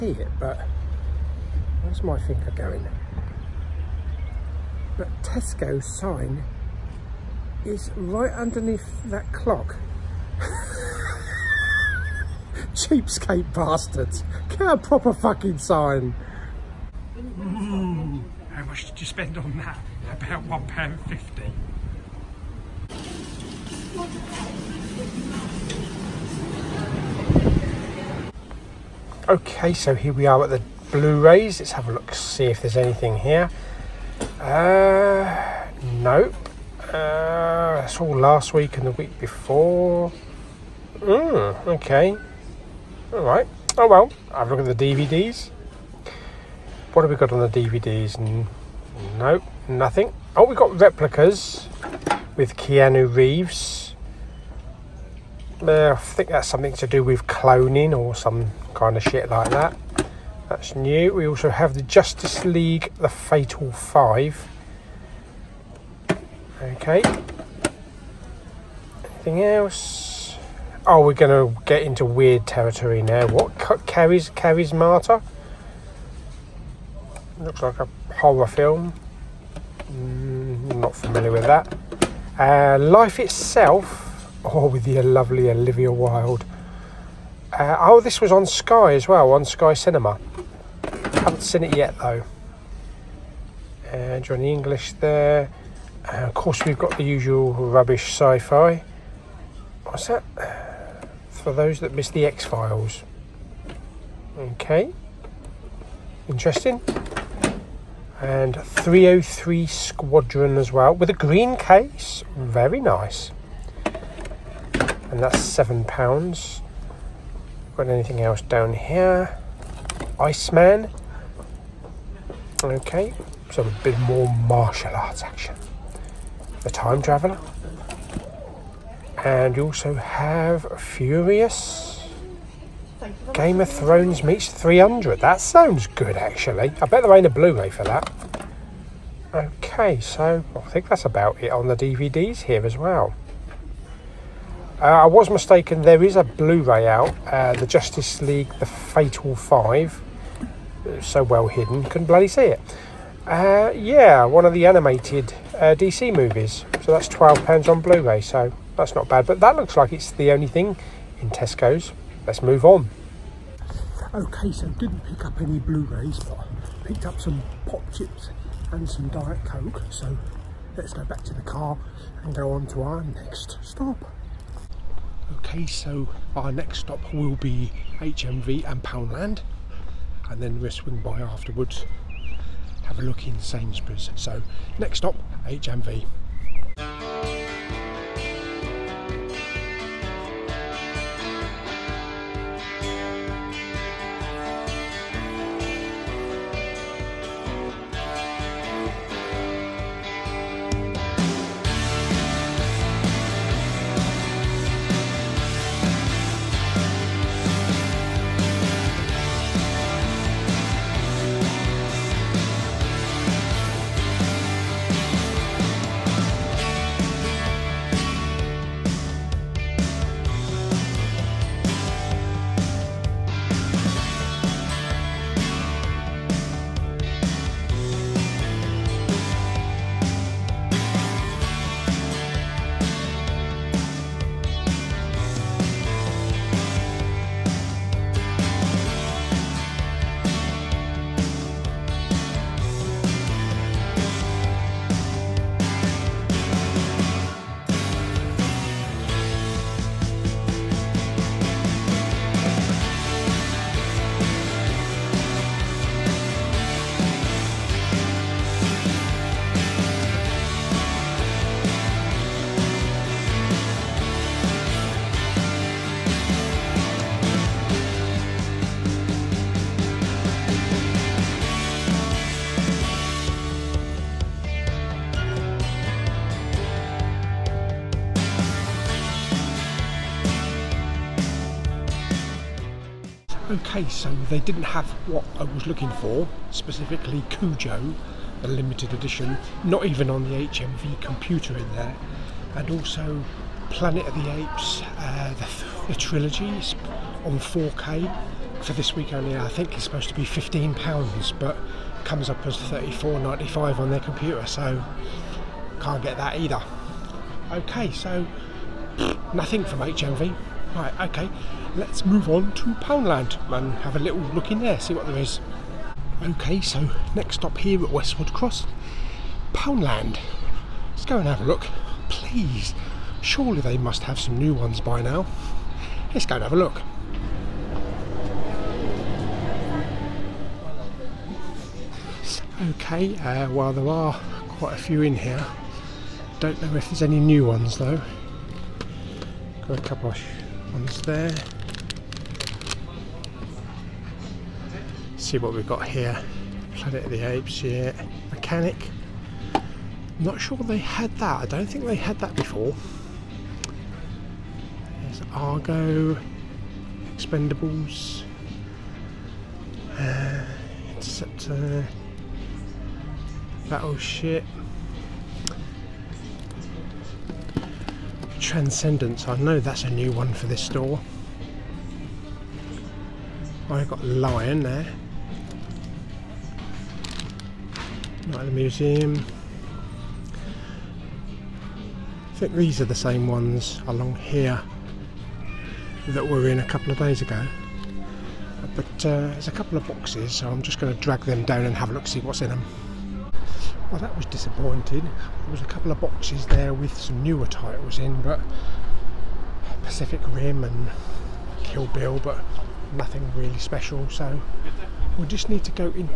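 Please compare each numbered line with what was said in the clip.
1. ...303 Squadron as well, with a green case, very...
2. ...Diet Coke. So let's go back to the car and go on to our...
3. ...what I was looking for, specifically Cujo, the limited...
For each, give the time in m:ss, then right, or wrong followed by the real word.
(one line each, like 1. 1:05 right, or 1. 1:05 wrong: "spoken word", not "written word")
1. 1:48 right
2. 2:49 right
3. 4:45 right.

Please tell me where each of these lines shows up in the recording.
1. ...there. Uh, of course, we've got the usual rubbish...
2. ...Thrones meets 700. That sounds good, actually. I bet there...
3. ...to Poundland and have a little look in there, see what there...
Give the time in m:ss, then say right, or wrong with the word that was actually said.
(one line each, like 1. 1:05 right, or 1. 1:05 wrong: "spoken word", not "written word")
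1. 1:34 right
2. 2:13 wrong: "300", not "700"
3. 5:12 right.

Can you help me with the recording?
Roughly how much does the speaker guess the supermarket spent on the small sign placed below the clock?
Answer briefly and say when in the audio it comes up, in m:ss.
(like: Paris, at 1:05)
£1.50, at 0:20.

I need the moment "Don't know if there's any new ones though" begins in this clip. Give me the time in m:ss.
5:36.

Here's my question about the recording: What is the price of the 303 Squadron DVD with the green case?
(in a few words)
7 pounds.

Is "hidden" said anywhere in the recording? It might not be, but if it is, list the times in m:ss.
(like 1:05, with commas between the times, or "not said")
2:31.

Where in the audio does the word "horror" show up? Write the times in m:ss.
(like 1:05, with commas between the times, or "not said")
1:18.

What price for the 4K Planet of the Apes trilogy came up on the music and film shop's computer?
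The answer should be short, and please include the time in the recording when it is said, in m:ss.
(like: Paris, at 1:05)
£34.95, at 5:02.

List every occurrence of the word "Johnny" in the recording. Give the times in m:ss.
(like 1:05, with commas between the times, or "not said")
1:34.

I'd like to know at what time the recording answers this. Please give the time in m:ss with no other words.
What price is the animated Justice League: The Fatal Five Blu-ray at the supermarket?
2:37.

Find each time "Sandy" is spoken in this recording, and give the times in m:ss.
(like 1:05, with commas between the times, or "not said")
not said.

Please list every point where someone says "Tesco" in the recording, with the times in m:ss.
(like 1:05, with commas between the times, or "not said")
0:05, 2:41.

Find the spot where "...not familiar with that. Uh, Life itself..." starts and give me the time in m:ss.
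1:20.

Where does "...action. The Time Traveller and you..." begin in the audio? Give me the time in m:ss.
2:05.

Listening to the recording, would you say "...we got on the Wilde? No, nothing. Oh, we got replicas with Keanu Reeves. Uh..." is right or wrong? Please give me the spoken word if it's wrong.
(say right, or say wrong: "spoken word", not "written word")
wrong: "DVDs", not "Wilde".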